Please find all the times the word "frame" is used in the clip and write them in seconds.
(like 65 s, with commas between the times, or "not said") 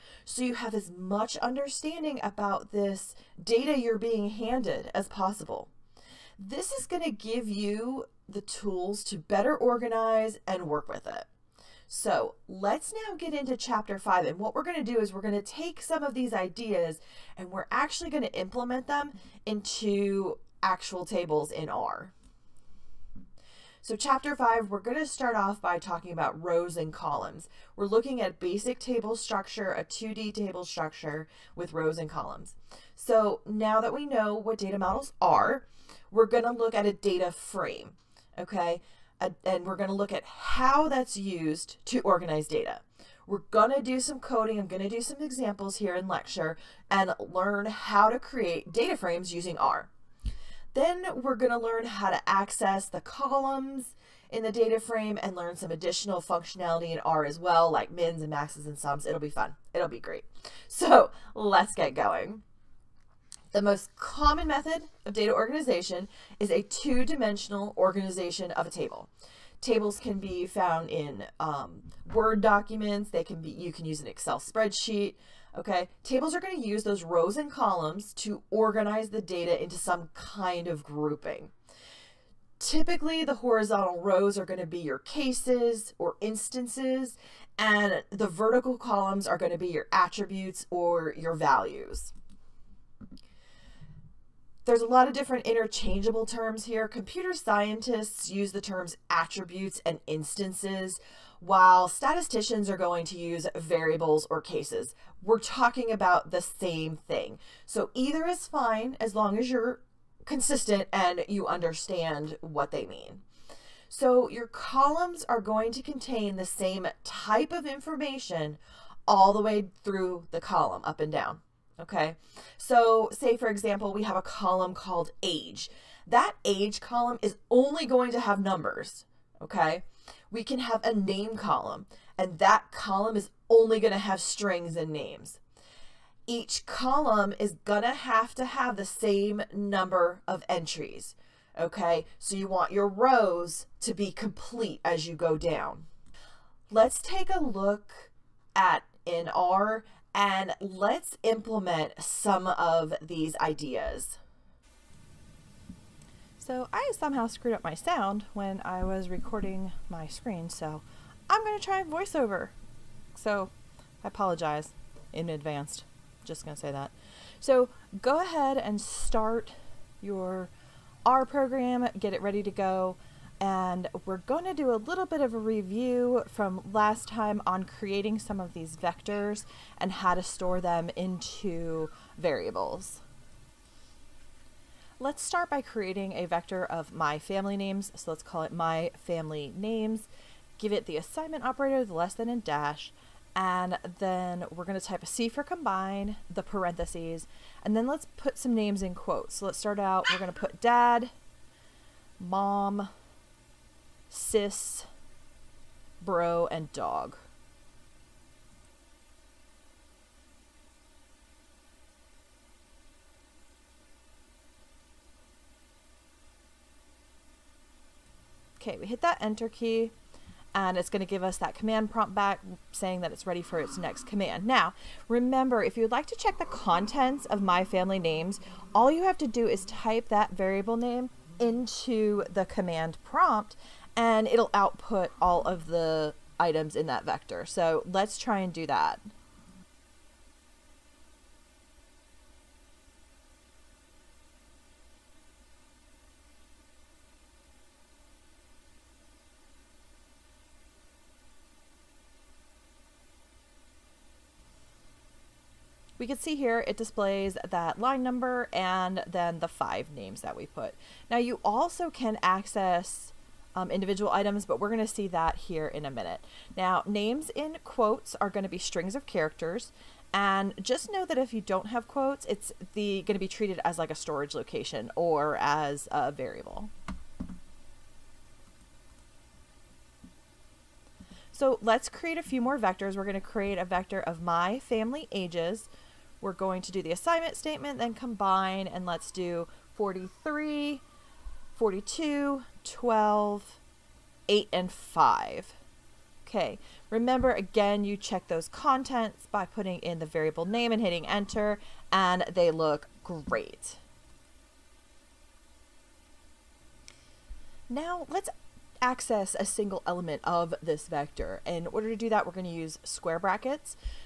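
37 s, 48 s, 54 s.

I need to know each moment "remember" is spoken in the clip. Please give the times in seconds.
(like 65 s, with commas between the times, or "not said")
225 s, 296 s.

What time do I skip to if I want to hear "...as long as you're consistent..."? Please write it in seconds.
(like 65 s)
109 s.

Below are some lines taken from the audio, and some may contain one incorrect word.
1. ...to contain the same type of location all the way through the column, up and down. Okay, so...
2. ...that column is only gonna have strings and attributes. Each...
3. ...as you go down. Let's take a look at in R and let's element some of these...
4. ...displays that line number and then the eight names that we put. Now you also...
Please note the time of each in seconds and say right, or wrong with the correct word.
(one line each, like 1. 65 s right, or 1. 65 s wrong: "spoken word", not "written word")
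1. 115 s wrong: "information", not "location"
2. 132 s wrong: "names", not "attributes"
3. 144 s wrong: "implement", not "element"
4. 256 s wrong: "five", not "eight".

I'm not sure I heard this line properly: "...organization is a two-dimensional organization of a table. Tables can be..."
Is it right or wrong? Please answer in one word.
right.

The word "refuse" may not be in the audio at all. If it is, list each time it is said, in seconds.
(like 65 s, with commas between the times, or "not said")
not said.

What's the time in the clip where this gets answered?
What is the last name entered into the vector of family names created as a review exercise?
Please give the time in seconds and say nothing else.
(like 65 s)
206 s.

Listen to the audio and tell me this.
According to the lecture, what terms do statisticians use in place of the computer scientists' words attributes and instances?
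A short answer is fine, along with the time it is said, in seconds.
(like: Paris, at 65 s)
variables or cases, at 103 s.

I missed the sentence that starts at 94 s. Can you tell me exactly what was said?
There's a lot of different interchangeable terms here.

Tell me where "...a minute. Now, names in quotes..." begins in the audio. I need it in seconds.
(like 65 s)
265 s.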